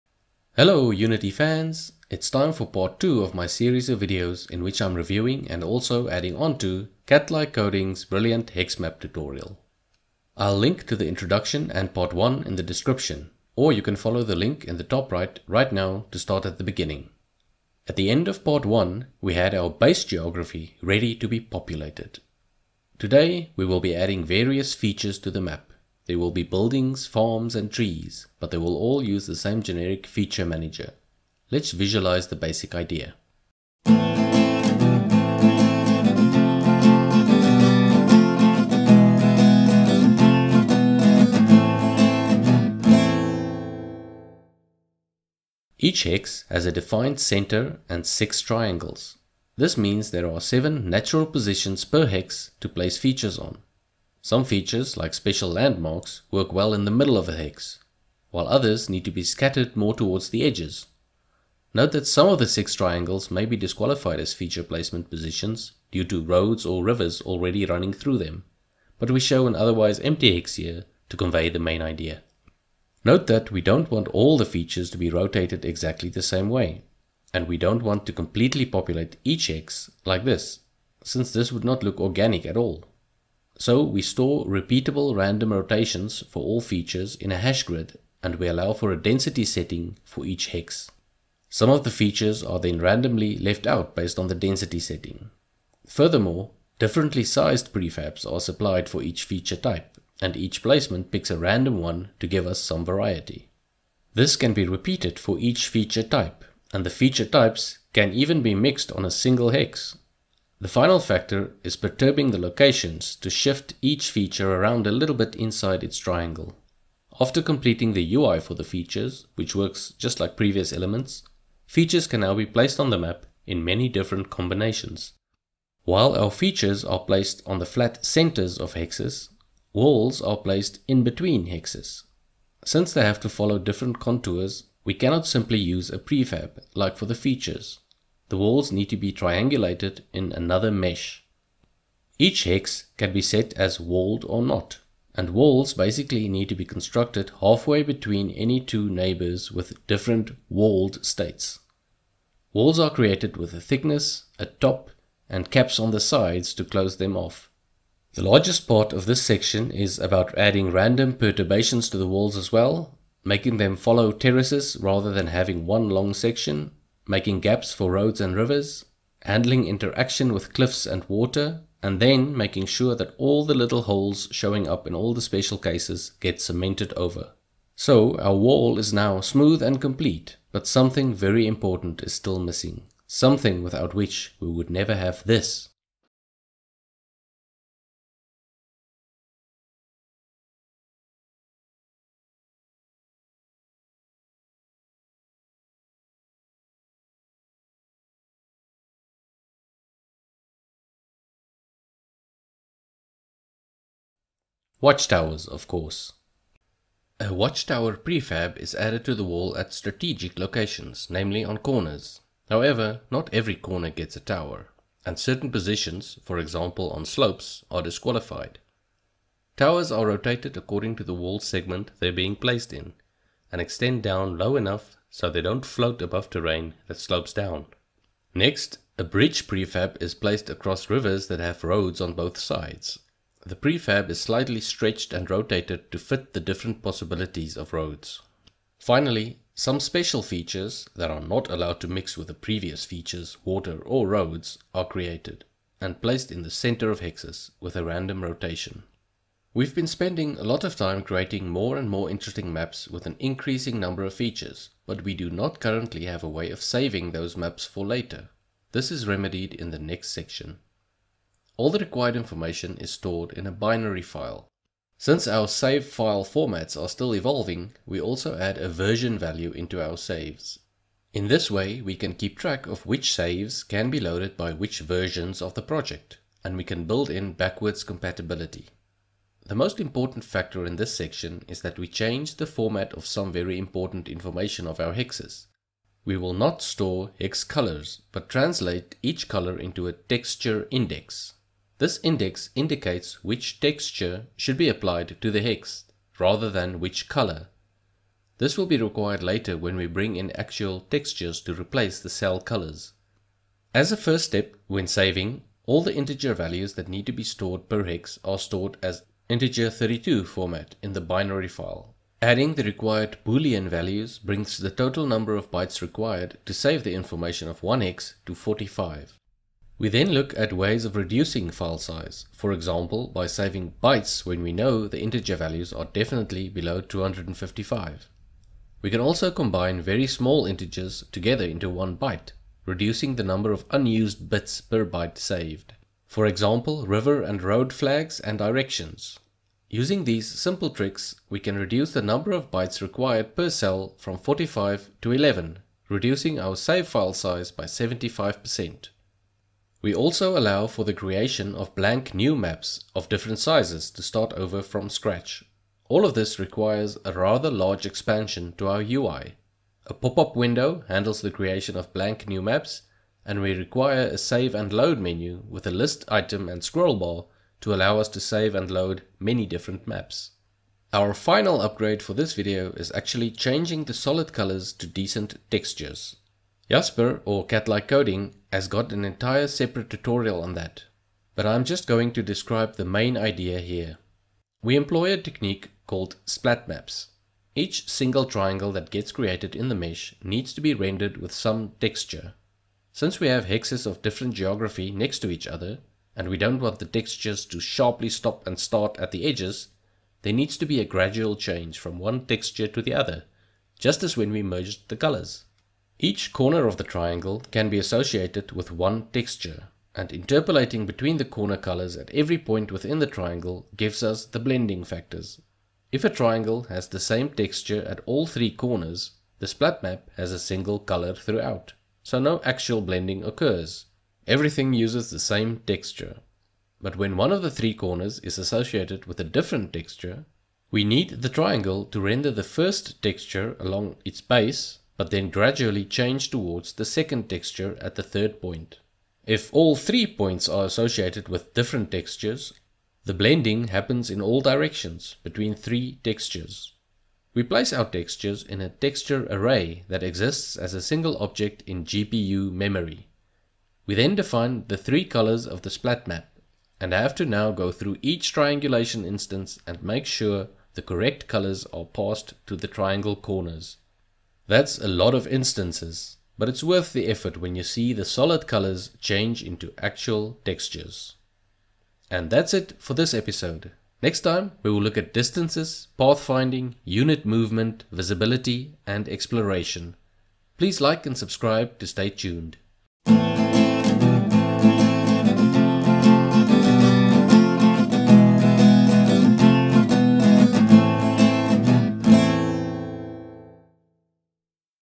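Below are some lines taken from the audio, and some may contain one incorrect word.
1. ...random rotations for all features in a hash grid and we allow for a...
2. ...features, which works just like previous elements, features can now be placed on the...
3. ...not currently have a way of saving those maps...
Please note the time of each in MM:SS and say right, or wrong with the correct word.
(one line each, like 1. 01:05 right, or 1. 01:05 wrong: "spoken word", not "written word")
1. 01:25 right
2. 01:58 right
3. 04:15 right.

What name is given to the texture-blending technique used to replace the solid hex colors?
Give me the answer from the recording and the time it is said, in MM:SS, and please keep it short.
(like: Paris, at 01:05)
splat maps, at 06:26.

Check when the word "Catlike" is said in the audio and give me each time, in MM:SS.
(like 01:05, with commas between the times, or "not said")
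00:07, 06:17.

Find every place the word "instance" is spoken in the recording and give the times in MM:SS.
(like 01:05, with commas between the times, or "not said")
07:39, 07:45.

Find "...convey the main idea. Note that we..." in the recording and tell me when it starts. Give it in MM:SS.
01:11.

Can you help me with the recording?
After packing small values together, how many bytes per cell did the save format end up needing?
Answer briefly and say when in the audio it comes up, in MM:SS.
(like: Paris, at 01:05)
11, at 05:45.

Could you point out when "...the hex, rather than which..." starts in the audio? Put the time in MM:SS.
04:55.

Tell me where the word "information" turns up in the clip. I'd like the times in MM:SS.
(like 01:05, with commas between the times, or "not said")
04:22, 04:44, 05:16.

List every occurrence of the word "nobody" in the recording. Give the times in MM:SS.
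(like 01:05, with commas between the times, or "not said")
not said.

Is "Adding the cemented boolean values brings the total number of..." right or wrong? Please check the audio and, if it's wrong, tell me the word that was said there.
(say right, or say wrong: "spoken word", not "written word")
wrong: "required", not "cemented".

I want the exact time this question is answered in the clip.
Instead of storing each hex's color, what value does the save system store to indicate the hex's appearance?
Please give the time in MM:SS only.
04:49.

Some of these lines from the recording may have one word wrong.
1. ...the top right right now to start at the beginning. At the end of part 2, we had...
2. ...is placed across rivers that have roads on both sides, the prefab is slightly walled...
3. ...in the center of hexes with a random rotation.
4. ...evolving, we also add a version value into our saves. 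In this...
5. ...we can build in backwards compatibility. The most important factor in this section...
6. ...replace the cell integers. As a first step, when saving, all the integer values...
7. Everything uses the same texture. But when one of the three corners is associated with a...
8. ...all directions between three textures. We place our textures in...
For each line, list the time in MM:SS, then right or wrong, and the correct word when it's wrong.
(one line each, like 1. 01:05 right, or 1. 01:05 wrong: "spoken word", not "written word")
1. 00:14 wrong: "1", not "2"
2. 03:50 wrong: "stretched", not "walled"
3. 04:06 right
4. 04:27 right
5. 04:36 right
6. 05:01 wrong: "colors", not "integers"
7. 07:04 right
8. 07:24 right.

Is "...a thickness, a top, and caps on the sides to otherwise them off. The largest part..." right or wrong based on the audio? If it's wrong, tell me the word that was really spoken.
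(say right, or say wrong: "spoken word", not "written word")
wrong: "close", not "otherwise".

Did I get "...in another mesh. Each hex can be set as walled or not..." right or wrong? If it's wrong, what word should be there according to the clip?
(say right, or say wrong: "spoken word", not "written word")
right.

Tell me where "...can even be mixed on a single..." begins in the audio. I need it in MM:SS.
01:47.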